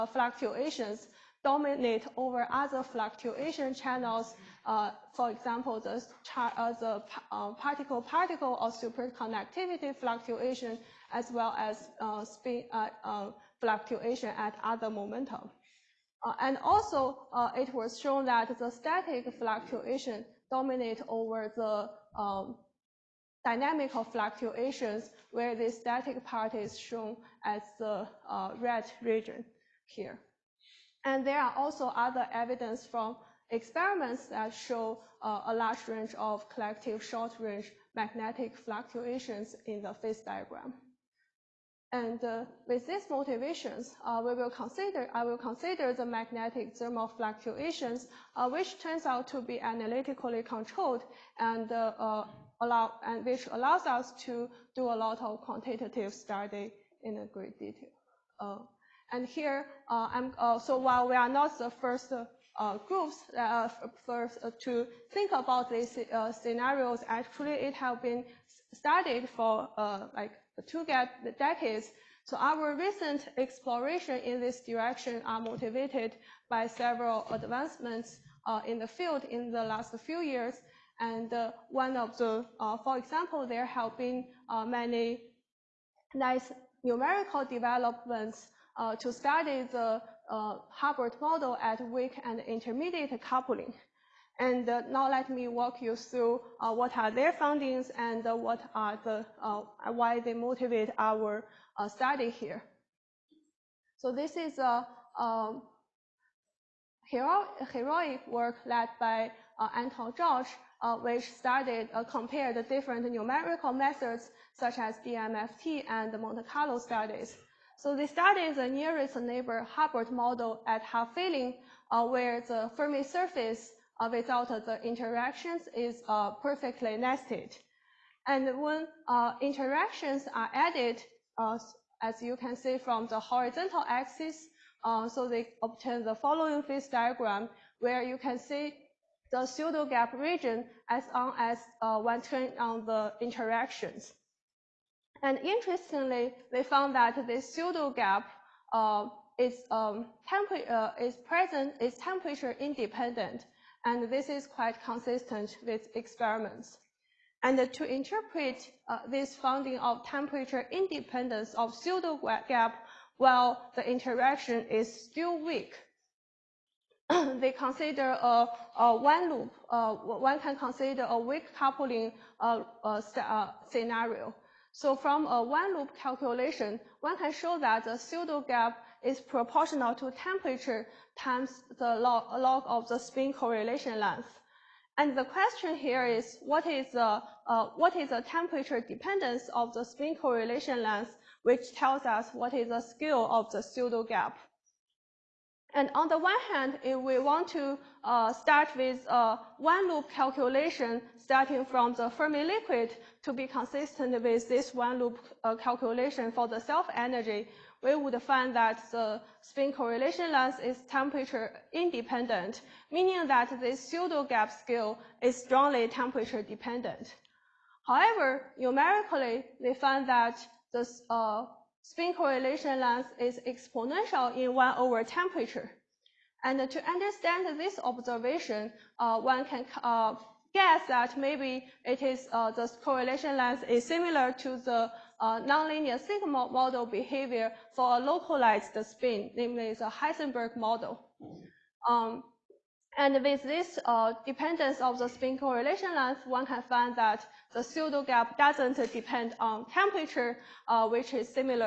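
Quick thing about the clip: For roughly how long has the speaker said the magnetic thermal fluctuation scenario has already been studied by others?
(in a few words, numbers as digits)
Two decades.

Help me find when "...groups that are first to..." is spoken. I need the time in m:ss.
1:02.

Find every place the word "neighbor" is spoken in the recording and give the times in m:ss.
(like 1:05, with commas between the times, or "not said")
1:59.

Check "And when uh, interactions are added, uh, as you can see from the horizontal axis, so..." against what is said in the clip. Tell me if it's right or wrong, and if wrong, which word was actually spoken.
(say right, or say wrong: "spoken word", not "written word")
right.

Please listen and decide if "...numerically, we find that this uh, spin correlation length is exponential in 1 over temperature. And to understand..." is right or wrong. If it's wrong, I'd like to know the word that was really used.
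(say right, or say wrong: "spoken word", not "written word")
right.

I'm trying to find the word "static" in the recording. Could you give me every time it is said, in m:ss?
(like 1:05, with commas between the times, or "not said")
0:18, 0:25.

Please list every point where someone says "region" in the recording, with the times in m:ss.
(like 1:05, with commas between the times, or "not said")
0:29, 2:20.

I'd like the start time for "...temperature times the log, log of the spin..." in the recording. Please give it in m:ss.
3:00.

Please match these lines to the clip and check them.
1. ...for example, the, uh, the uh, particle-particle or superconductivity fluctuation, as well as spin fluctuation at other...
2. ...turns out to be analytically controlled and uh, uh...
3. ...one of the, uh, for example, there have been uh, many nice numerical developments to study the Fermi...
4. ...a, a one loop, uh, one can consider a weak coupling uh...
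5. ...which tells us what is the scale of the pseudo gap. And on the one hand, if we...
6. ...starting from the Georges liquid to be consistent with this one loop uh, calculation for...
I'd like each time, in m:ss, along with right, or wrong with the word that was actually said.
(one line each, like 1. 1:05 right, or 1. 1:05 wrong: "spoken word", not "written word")
1. 0:05 right
2. 0:48 right
3. 1:21 wrong: "Hubbard", not "Fermi"
4. 2:48 right
5. 3:11 right
6. 3:21 wrong: "Fermi", not "Georges".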